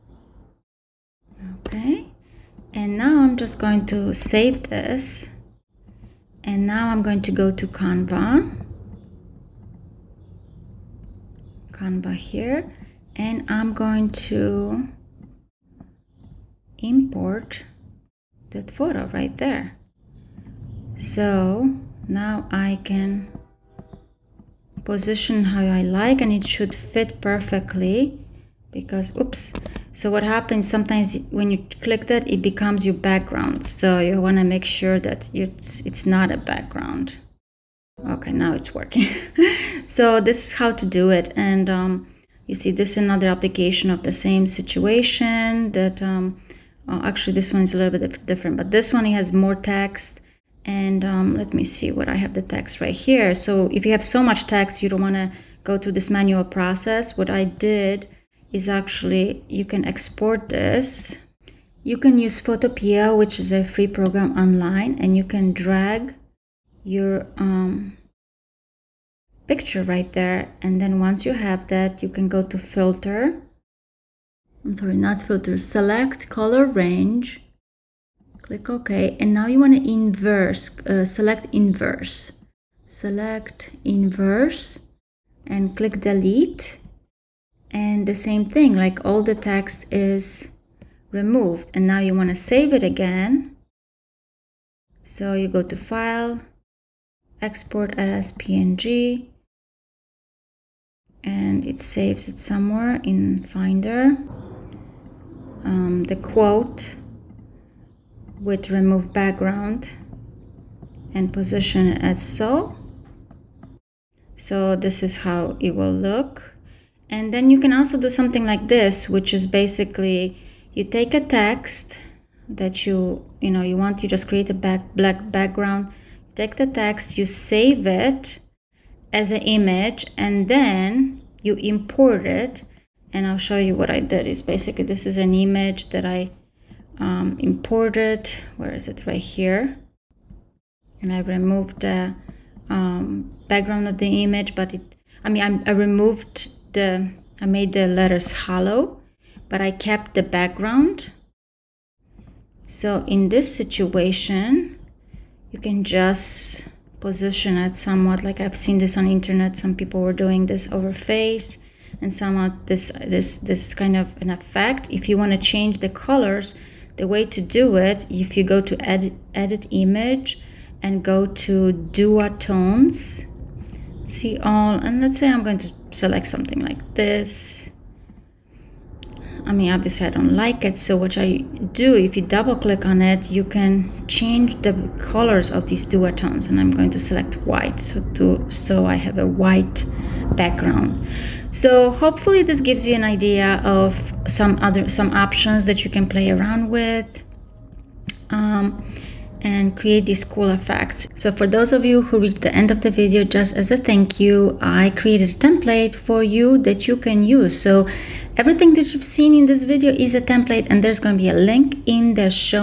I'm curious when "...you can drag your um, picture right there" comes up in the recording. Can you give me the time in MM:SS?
01:05.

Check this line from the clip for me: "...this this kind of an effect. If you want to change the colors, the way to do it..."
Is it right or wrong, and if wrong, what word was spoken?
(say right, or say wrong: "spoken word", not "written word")
right.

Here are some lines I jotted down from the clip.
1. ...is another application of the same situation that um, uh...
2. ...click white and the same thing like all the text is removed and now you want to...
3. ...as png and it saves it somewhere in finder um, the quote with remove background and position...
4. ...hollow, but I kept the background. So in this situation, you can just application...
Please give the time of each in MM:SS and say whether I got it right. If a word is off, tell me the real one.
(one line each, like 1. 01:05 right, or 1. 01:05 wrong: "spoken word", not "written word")
1. 00:42 right
2. 01:25 wrong: "delete", not "white"
3. 01:37 right
4. 02:28 wrong: "position", not "application".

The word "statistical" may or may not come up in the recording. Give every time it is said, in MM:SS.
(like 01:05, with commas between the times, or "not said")
not said.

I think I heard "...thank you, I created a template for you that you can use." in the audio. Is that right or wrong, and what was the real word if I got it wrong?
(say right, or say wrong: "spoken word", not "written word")
right.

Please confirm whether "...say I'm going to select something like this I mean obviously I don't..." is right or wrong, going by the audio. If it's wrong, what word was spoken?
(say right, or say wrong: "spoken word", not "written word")
right.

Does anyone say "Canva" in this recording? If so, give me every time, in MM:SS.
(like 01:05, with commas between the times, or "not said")
00:07, 00:11.